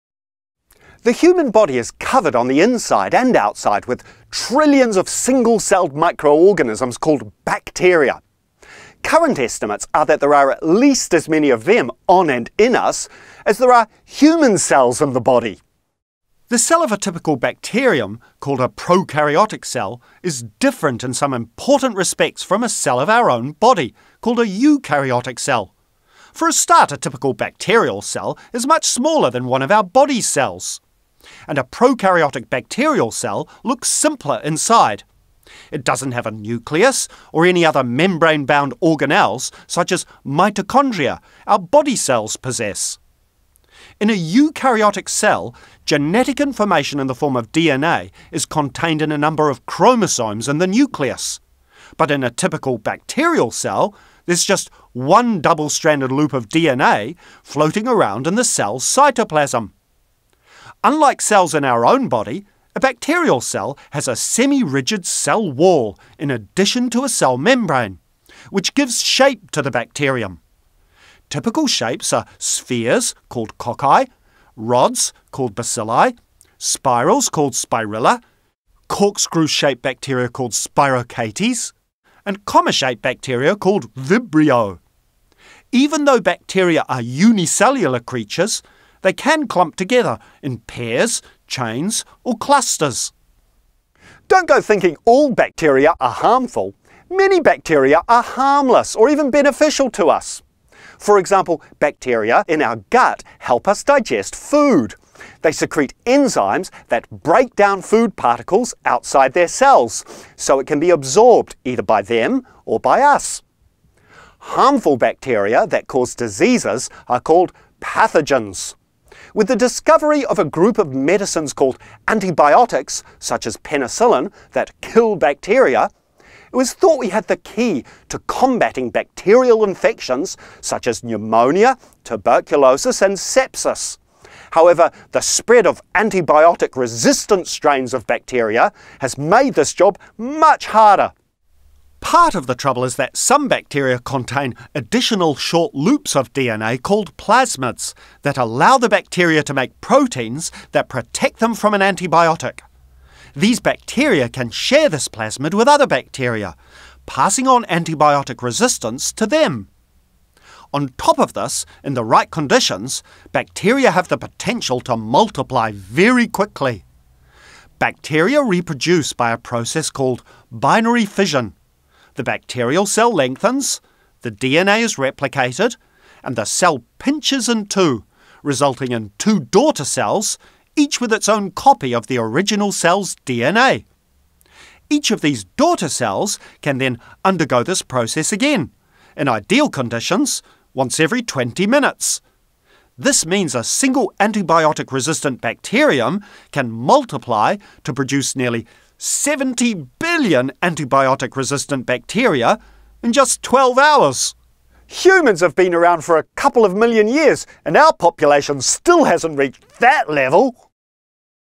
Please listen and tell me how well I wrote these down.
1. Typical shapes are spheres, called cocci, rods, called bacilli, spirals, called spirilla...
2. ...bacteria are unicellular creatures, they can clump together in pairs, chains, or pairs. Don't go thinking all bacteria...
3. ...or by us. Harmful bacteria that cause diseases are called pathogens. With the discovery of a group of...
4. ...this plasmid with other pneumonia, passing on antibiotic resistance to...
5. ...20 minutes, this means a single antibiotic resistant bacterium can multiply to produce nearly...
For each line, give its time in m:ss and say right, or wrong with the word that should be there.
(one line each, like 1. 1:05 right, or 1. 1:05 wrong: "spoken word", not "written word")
1. 1:11 right
2. 1:26 wrong: "clusters", not "pairs"
3. 1:52 right
4. 2:34 wrong: "bacteria", not "pneumonia"
5. 3:11 right.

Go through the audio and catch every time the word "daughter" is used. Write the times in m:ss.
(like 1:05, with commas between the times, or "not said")
2:59, 3:05.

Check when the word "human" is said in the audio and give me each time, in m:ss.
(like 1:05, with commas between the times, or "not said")
0:01, 0:14, 3:24.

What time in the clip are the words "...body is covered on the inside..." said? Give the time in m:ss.
0:01.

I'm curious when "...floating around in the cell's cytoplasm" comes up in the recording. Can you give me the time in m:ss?
0:57.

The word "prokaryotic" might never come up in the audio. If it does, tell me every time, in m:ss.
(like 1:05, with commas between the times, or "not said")
0:18, 0:31.